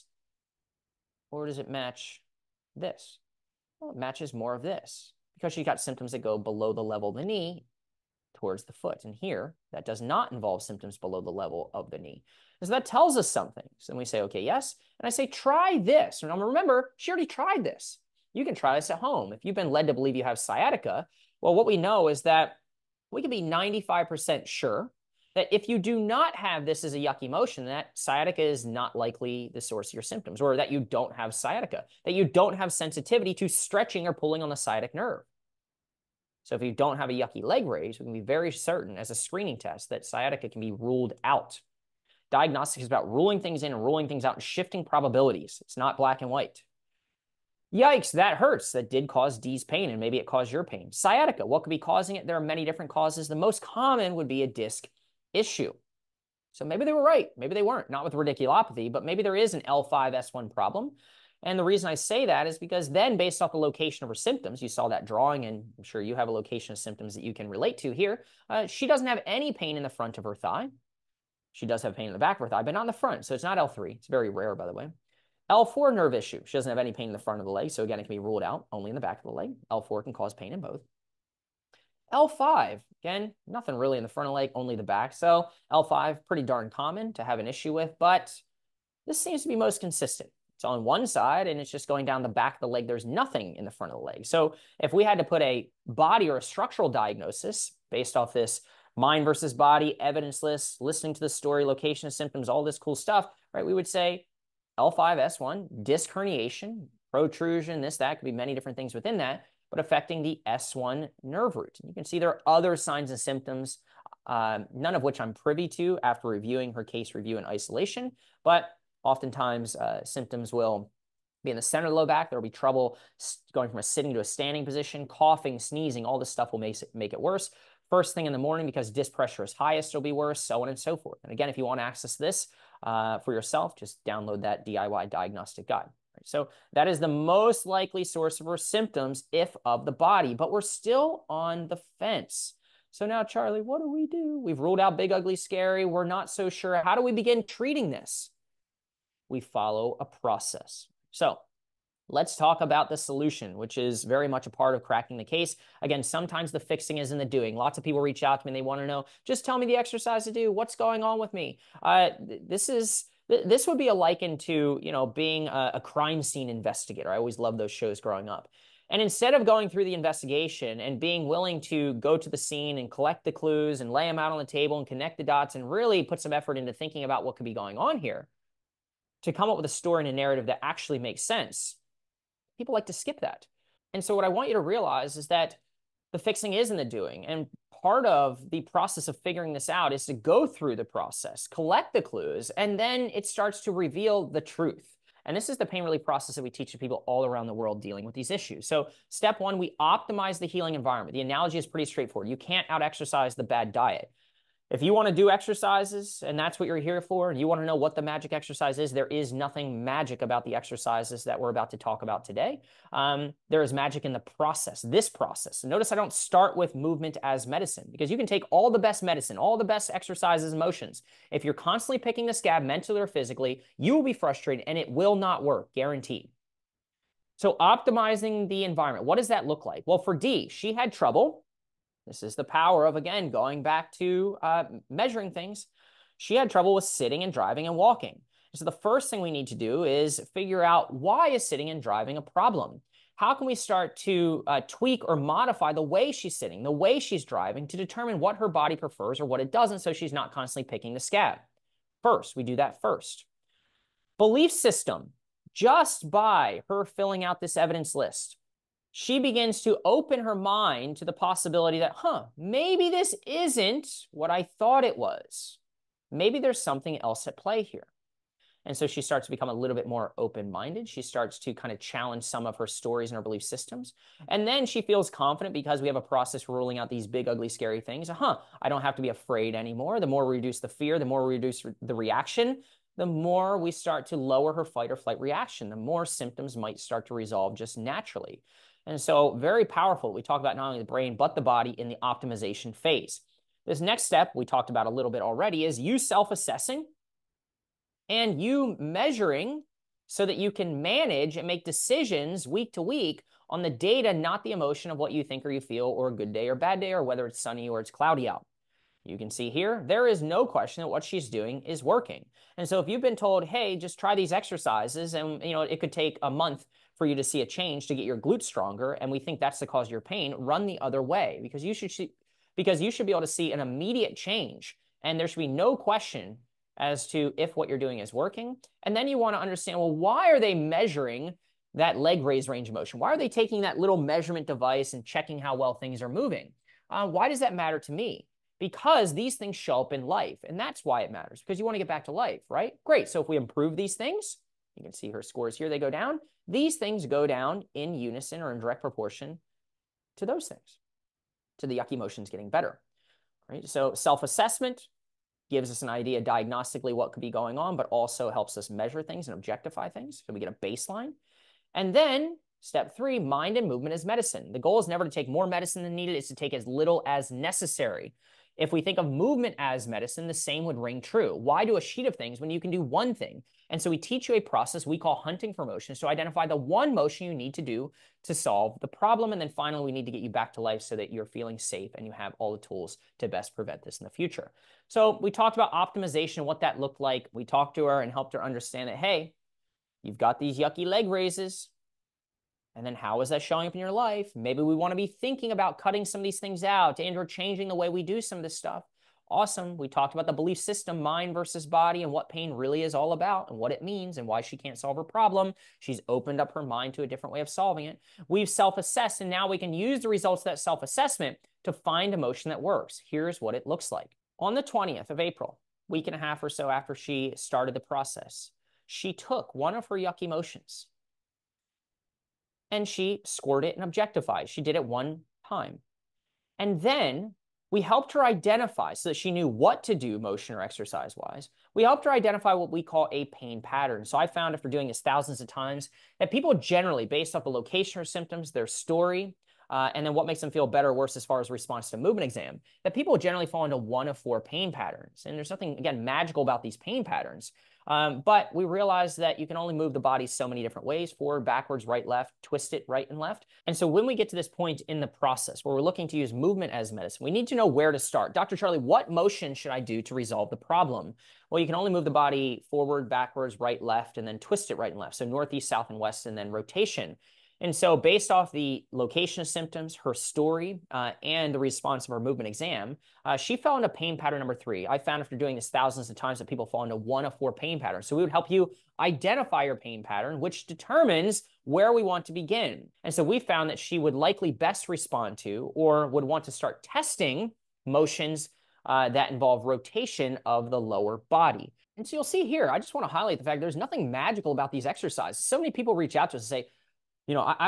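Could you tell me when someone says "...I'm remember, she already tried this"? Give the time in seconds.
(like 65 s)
16 s.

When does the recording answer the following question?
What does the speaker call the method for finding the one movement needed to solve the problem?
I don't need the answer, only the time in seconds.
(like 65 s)
375 s.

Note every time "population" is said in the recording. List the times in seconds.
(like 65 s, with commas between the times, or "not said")
not said.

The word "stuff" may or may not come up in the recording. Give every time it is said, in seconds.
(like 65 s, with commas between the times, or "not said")
102 s, 126 s, 398 s.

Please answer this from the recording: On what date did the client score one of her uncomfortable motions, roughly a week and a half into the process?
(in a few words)
April 20.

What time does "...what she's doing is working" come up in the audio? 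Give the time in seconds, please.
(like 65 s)
310 s.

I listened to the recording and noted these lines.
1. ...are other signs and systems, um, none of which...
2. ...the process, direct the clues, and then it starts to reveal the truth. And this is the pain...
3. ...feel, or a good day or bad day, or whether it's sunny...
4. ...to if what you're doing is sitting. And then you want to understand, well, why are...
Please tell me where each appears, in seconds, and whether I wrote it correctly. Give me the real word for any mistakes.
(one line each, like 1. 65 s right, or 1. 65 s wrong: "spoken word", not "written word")
1. 112 s wrong: "symptoms", not "systems"
2. 190 s wrong: "collect", not "direct"
3. 305 s right
4. 327 s wrong: "working", not "sitting".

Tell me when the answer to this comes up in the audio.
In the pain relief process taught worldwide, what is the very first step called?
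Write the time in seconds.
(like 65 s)
199 s.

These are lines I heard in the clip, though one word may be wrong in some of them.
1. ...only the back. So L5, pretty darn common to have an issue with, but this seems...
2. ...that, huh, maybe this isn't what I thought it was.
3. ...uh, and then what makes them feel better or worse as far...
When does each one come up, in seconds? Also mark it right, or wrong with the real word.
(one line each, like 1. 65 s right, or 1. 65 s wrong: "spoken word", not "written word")
1. 84 s right
2. 261 s right
3. 439 s right.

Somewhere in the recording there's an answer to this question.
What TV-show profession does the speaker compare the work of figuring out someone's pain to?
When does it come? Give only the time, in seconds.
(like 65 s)
165 s.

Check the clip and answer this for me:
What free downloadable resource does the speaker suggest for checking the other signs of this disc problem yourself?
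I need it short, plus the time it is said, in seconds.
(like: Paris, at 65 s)
DIY diagnostic guide, at 134 s.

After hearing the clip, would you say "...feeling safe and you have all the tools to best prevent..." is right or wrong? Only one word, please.
right.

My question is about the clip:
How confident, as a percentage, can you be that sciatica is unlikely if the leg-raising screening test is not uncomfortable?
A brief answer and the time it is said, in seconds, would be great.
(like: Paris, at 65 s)
95%, at 23 s.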